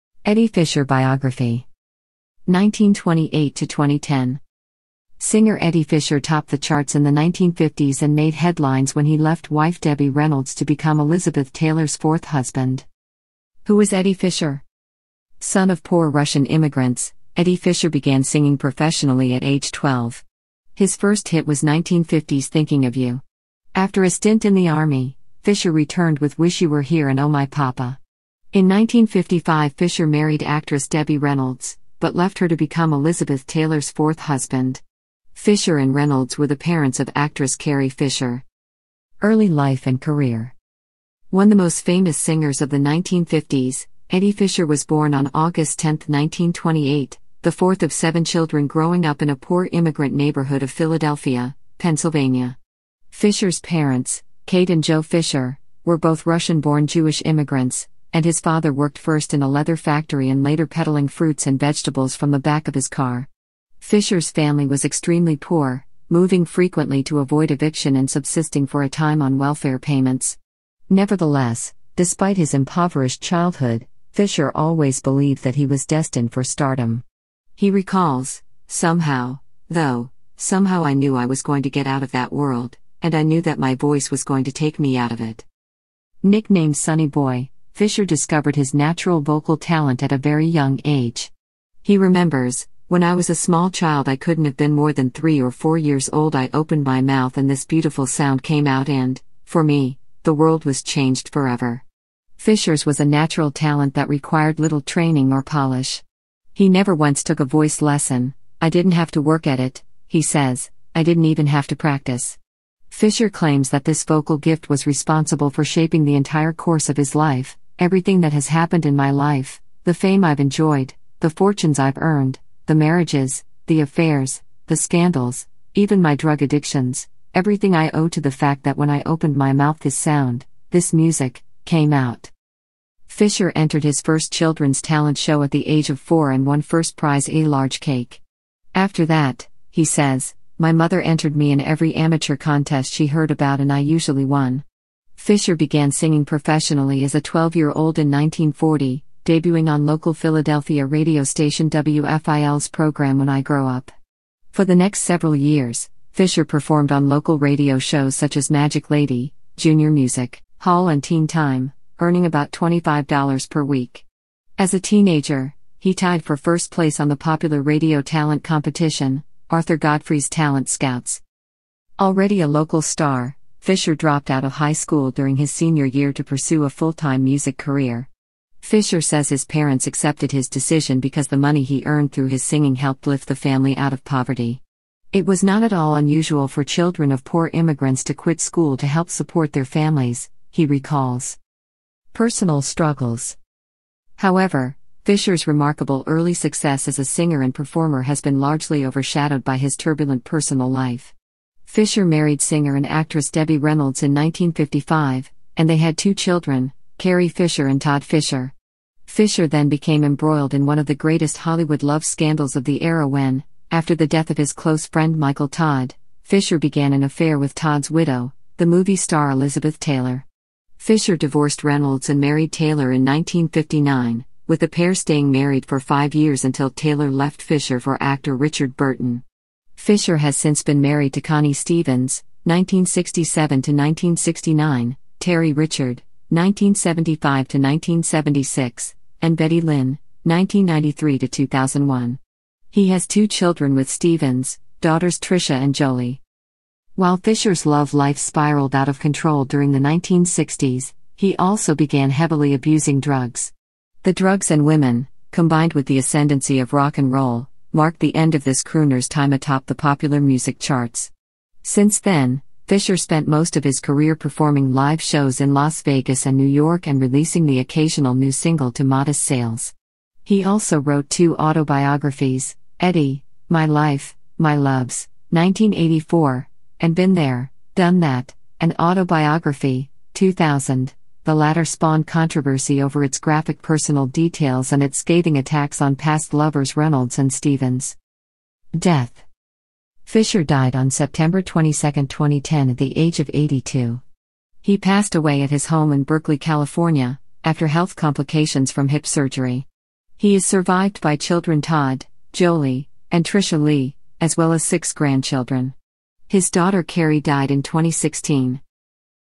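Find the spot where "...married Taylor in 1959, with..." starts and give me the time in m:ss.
3:42.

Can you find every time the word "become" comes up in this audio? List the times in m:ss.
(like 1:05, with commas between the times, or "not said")
0:10, 0:32.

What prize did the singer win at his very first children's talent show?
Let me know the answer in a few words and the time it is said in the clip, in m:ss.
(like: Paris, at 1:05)
A large cake, at 2:17.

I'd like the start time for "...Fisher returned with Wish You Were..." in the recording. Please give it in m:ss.
0:25.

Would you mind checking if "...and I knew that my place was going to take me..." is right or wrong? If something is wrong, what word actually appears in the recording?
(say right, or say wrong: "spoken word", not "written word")
wrong: "voice", not "place".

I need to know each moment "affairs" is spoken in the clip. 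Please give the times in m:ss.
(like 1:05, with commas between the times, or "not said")
2:03, 3:37.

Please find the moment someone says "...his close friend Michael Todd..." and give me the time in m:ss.
3:34.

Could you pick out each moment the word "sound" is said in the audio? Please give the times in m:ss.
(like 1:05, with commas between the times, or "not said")
1:38, 2:09.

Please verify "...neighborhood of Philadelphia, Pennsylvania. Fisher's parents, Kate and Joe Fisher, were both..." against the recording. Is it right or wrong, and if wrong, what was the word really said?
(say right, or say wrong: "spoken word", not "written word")
right.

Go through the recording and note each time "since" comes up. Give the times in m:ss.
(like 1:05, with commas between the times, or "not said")
3:50, 4:21.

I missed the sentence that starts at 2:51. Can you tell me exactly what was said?
Already a local star, Fisher dropped out of high school during his senior year to pursue a full time music career.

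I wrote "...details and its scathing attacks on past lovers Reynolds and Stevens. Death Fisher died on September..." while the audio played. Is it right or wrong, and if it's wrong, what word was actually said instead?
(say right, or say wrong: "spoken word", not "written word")
right.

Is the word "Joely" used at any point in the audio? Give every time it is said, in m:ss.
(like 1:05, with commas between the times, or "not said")
4:05, 5:02.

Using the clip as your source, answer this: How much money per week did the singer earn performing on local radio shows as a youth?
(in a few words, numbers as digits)
$25.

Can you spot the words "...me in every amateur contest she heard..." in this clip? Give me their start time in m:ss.
2:21.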